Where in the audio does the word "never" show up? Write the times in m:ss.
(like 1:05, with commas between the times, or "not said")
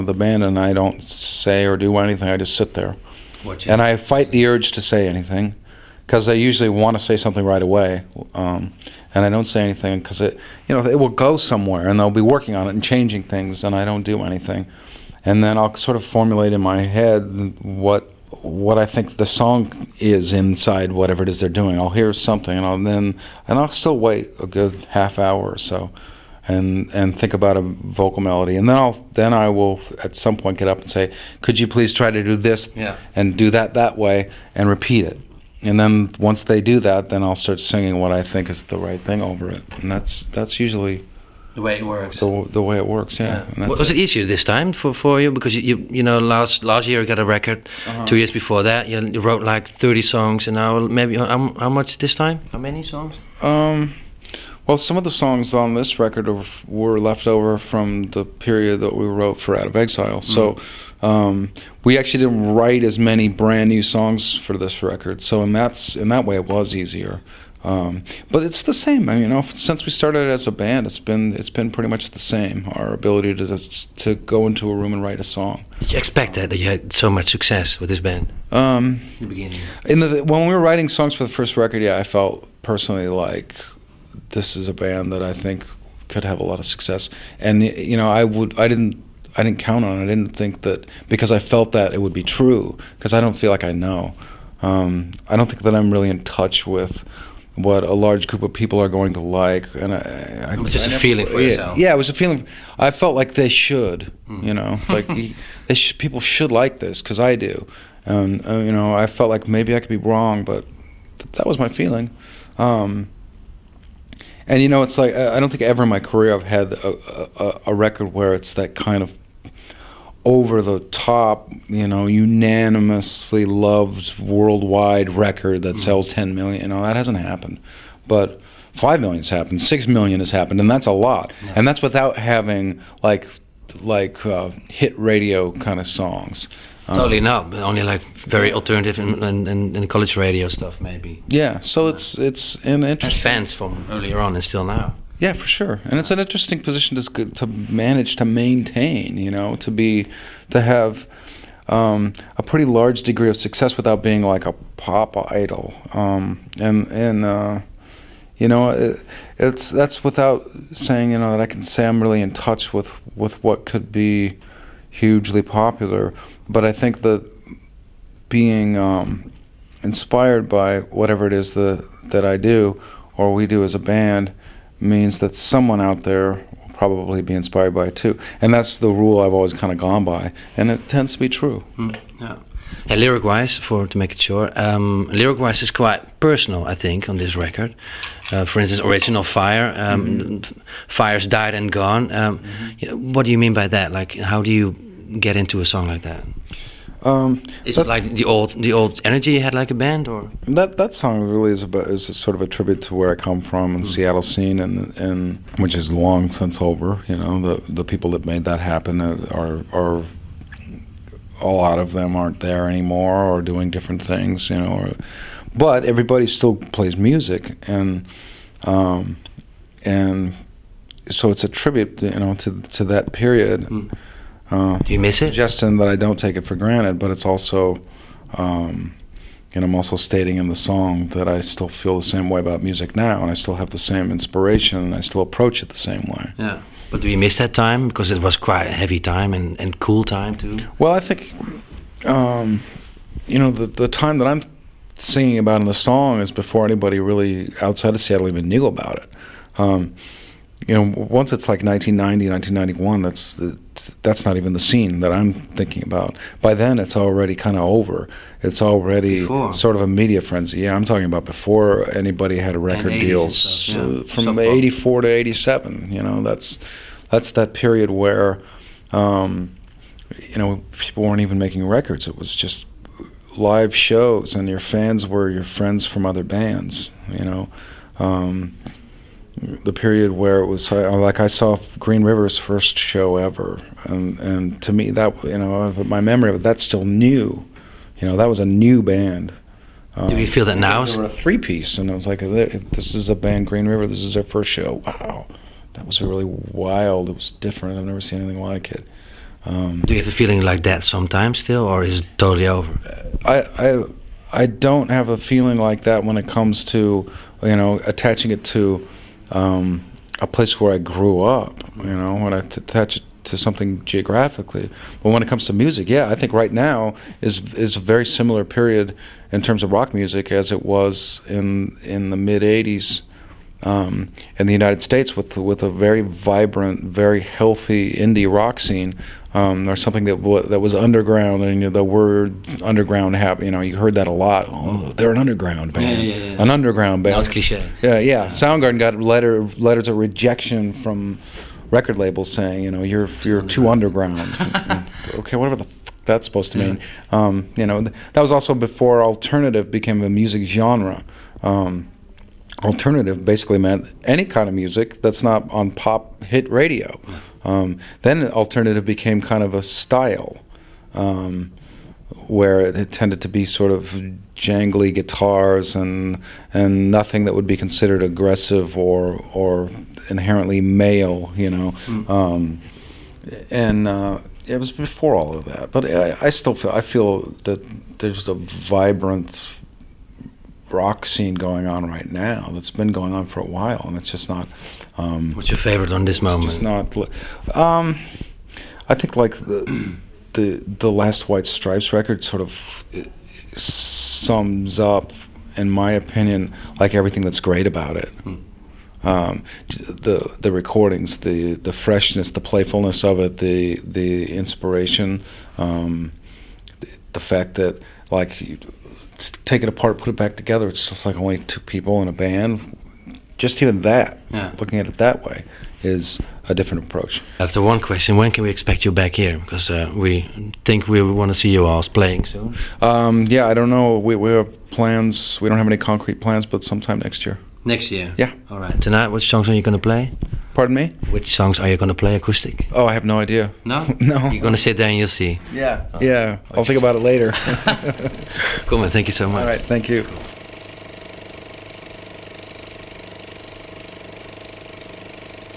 1:40, 4:57.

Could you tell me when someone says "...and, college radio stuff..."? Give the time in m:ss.
2:19.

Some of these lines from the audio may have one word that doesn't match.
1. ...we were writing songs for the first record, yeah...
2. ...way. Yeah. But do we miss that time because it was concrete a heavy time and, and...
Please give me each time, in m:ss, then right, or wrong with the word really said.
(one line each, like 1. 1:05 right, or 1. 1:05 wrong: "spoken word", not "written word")
1. 1:20 right
2. 3:56 wrong: "quite", not "concrete".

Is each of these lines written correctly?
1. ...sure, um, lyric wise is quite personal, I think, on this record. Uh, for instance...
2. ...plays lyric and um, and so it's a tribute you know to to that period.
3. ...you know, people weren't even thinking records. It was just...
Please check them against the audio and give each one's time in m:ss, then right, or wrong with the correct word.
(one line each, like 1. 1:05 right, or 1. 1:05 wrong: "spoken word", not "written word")
1. 3:04 right
2. 3:36 wrong: "music", not "lyric"
3. 4:30 wrong: "making", not "thinking".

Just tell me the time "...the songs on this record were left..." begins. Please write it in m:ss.
0:55.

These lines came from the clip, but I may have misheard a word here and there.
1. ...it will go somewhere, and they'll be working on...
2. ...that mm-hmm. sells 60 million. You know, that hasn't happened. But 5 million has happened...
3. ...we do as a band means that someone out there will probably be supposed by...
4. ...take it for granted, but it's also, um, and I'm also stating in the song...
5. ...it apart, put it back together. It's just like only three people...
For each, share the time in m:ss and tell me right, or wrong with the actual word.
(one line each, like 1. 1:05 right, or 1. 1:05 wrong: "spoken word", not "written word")
1. 0:10 right
2. 2:05 wrong: "10", not "60"
3. 2:53 wrong: "inspired", not "supposed"
4. 3:46 right
5. 6:49 wrong: "two", not "three".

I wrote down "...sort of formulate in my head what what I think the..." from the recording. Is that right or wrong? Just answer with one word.
right.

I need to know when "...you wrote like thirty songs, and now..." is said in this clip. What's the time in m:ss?
0:49.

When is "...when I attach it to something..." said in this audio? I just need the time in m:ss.
5:12.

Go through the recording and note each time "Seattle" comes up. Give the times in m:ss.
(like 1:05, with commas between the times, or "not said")
3:23, 4:08.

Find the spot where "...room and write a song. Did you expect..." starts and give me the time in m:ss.
1:14.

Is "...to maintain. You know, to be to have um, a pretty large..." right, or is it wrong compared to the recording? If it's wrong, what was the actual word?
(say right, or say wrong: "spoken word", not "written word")
right.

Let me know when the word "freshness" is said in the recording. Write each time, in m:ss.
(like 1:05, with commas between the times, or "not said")
6:41.